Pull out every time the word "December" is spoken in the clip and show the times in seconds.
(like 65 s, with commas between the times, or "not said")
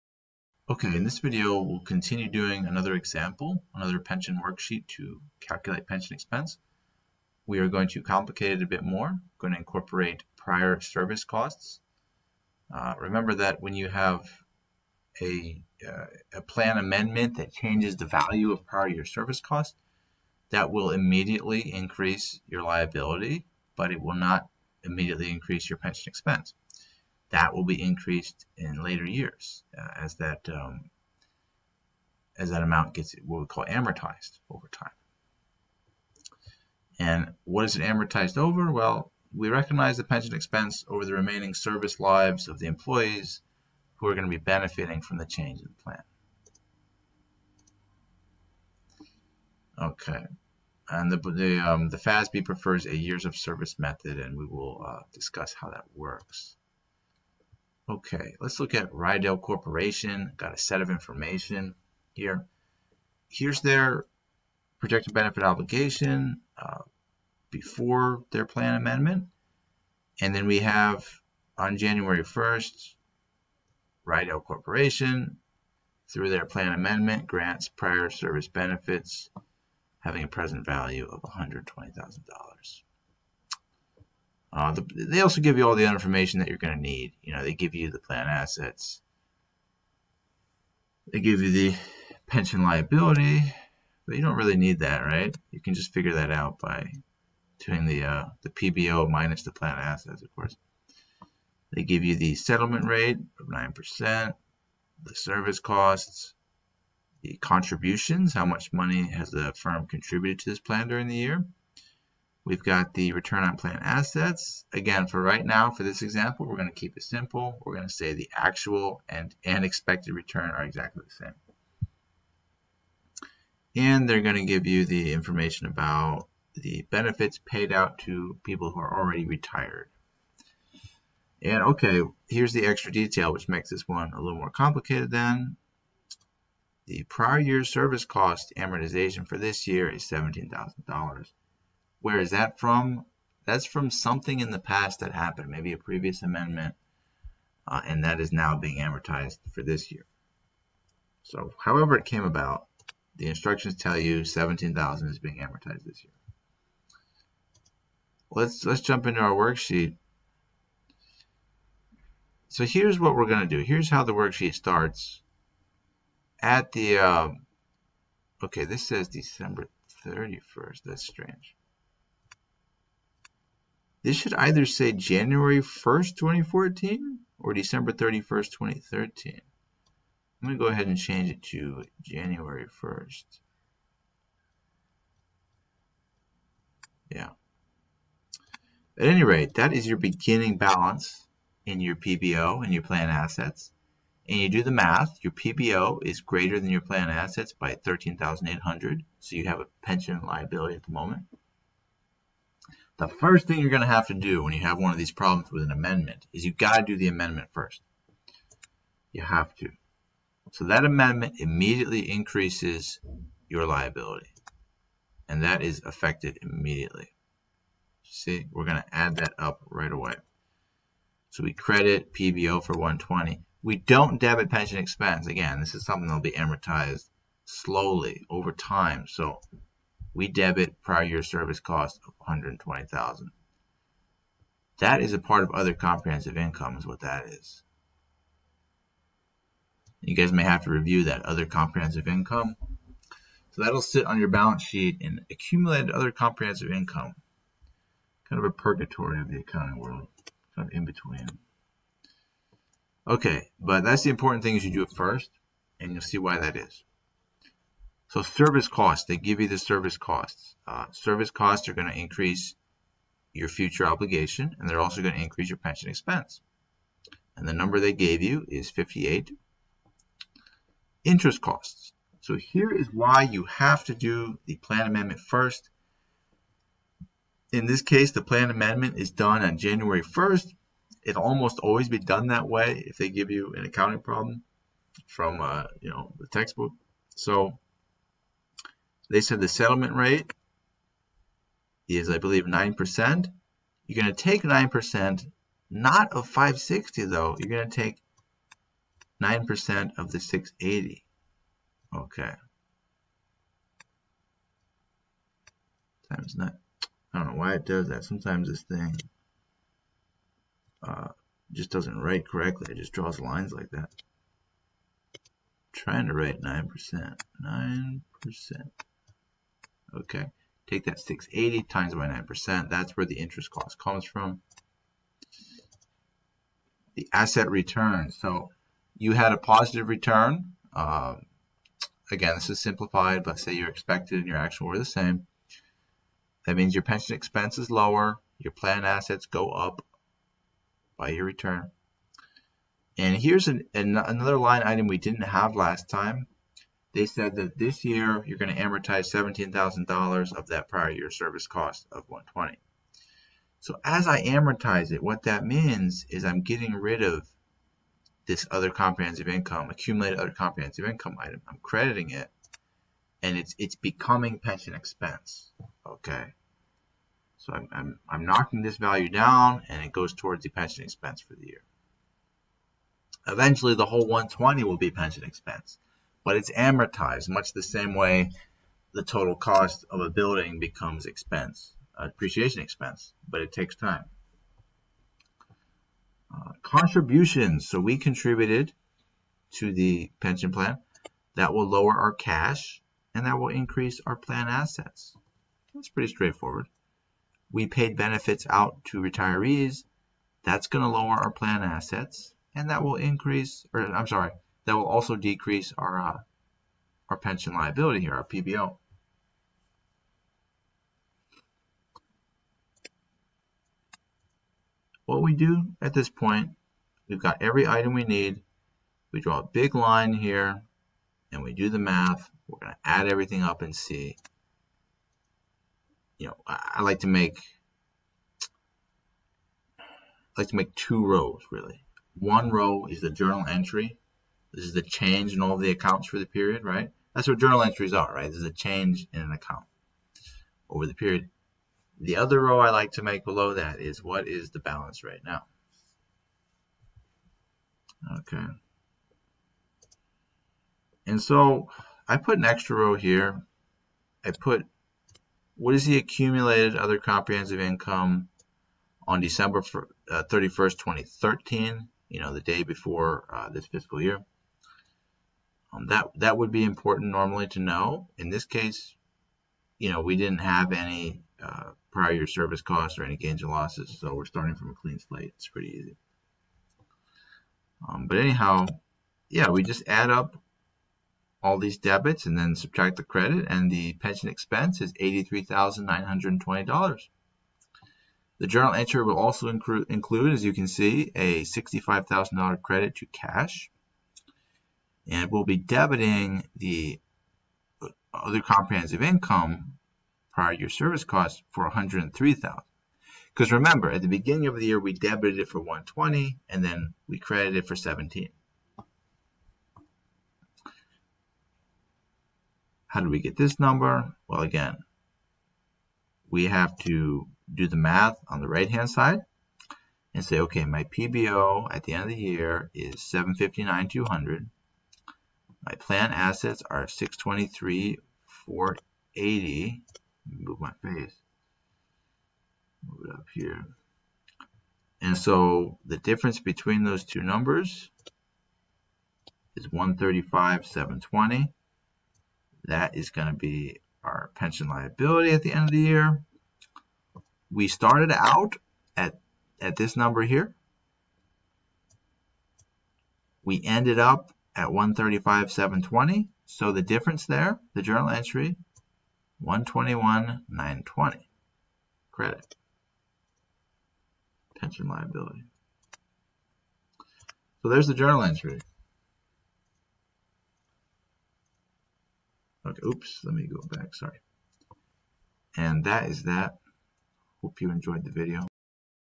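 169 s, 177 s, 459 s.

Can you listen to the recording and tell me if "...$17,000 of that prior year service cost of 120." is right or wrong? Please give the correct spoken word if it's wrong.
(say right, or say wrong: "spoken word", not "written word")
right.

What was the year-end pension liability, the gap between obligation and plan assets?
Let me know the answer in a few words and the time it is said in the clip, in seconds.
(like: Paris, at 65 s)
135,720, at 539 s.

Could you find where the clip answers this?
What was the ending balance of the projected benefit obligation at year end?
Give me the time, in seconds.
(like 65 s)
523 s.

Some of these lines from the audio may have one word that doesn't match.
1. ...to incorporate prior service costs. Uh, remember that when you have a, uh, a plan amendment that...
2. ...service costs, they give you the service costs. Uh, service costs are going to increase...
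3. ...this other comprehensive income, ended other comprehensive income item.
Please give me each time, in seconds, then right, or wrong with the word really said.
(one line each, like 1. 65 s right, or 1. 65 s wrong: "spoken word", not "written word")
1. 9 s right
2. 258 s right
3. 358 s wrong: "accumulated", not "ended".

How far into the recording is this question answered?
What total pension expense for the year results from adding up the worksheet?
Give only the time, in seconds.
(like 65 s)
484 s.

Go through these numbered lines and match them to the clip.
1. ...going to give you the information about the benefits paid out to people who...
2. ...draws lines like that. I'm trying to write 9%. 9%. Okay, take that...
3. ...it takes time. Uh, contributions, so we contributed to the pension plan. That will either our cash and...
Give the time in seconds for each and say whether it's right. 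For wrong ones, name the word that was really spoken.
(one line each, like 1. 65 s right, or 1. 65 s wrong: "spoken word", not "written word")
1. 124 s right
2. 312 s right
3. 383 s wrong: "lower", not "either".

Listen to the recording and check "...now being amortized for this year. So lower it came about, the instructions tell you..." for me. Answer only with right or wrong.
wrong.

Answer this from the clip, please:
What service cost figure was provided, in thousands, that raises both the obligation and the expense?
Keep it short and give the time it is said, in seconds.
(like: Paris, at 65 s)
58, at 268 s.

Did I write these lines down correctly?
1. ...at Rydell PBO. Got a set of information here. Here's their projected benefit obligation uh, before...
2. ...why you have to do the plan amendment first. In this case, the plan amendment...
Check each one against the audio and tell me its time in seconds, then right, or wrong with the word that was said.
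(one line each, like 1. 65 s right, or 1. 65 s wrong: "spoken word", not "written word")
1. 58 s wrong: "Corporation", not "PBO"
2. 272 s right.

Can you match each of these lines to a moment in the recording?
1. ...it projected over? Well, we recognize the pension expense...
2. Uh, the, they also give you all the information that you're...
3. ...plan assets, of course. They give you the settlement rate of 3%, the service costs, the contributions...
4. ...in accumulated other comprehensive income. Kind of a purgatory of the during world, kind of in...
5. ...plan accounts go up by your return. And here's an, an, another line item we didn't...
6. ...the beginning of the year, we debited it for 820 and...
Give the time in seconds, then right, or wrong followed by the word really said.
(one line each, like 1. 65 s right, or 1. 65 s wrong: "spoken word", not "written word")
1. 37 s wrong: "amortized", not "projected"
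2. 84 s right
3. 99 s wrong: "9", not "3"
4. 245 s wrong: "accounting", not "during"
5. 338 s wrong: "assets", not "accounts"
6. 504 s wrong: "120", not "820".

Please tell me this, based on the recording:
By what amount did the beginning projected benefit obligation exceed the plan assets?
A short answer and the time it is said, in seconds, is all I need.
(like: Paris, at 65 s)
13,800, at 197 s.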